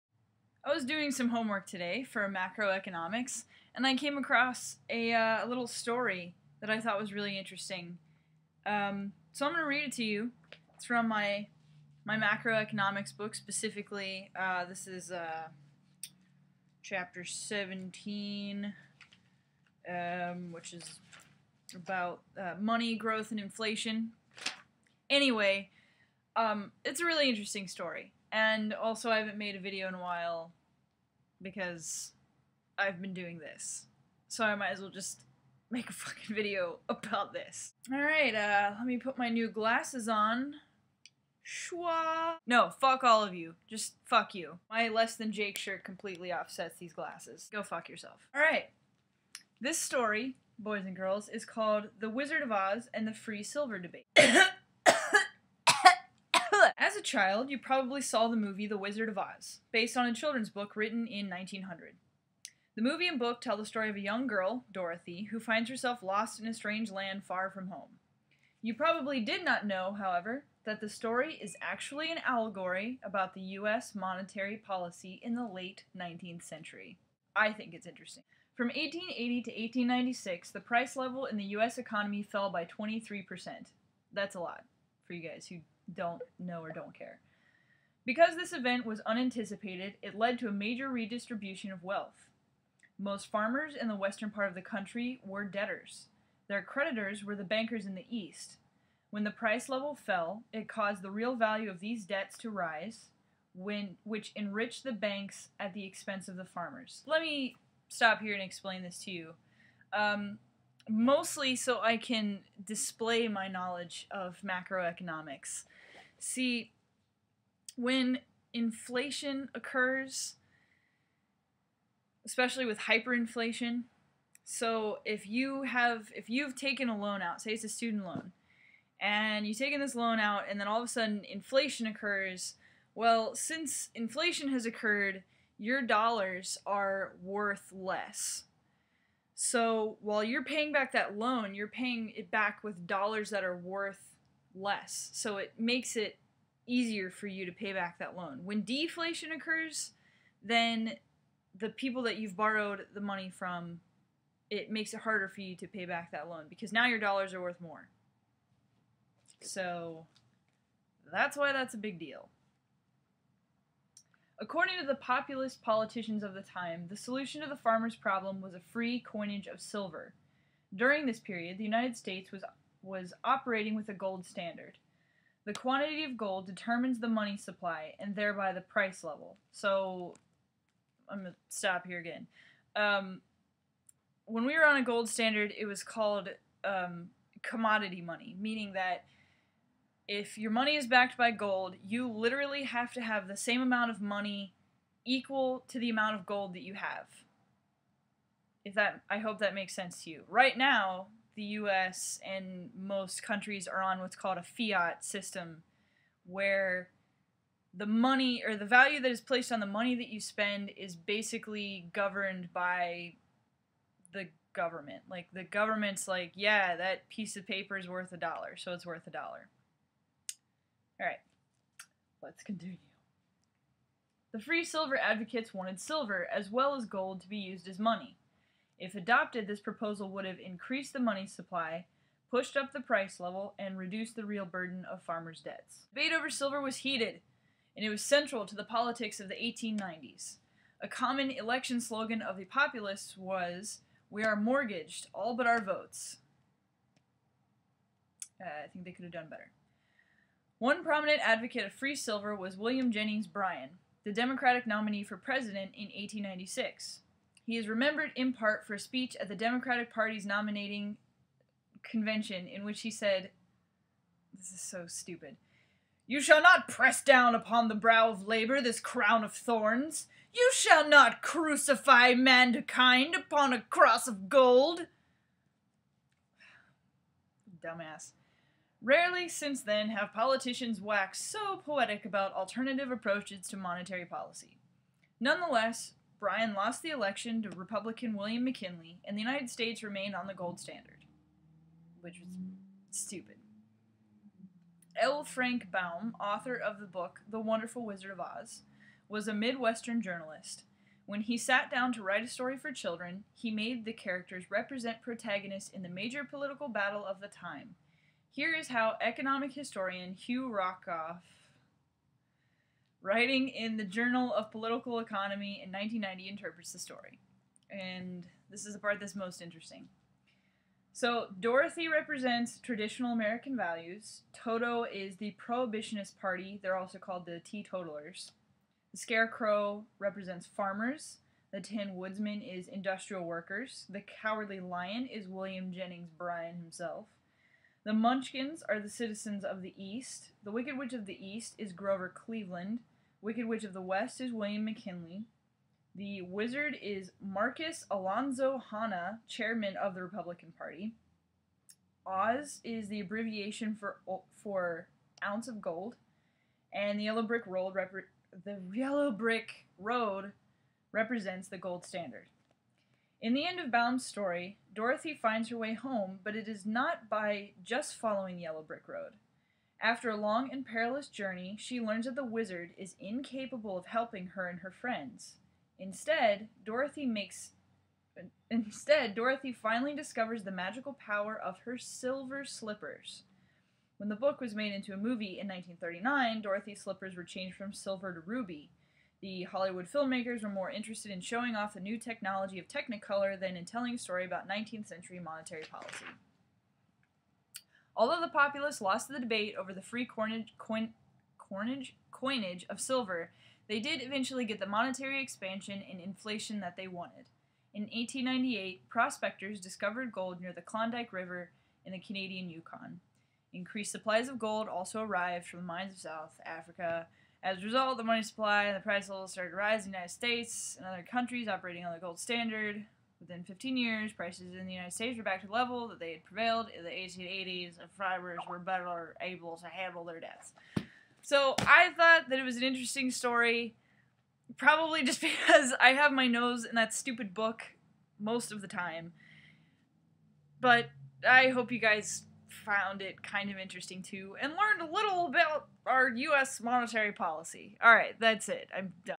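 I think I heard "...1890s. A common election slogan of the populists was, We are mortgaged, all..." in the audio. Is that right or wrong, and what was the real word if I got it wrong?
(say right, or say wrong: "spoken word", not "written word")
right.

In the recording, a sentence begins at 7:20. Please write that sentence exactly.
But I hope you guys found it kind of interesting too and learned a little about our US monetary policy.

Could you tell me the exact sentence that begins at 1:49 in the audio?
Um, mostly so I can display my knowledge of macroeconomics.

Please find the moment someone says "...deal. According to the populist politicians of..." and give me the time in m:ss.
2:41.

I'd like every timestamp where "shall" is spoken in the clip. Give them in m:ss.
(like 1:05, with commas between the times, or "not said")
4:26, 4:30.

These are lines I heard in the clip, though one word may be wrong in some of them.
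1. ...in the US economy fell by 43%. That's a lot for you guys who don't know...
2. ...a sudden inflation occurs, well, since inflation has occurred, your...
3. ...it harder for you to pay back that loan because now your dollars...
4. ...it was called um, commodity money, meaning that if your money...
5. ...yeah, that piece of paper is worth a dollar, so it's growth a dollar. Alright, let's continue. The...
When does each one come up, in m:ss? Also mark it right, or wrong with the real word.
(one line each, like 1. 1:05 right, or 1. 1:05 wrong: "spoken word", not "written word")
1. 1:21 wrong: "23", not "43"
2. 2:10 right
3. 2:34 right
4. 3:05 right
5. 3:36 wrong: "worth", not "growth".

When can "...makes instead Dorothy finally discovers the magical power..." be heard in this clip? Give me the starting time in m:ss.
6:17.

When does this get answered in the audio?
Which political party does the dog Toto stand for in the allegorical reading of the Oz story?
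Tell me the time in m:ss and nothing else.
5:25.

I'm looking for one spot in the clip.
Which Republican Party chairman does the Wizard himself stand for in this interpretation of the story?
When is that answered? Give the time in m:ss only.
5:47.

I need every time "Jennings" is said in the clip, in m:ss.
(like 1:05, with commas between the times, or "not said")
4:12, 5:35.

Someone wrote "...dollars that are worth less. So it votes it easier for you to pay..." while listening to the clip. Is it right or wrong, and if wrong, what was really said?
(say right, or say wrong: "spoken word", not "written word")
wrong: "makes", not "votes".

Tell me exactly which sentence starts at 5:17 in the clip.
And this is the part that's most interesting.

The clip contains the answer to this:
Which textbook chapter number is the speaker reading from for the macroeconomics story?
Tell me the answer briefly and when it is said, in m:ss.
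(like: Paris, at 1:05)
17, at 0:17.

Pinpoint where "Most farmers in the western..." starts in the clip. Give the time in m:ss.
1:32.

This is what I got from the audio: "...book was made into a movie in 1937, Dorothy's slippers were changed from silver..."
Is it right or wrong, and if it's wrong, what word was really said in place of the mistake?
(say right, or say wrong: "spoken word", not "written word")
wrong: "1939", not "1937".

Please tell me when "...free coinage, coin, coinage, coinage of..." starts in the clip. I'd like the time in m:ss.
6:39.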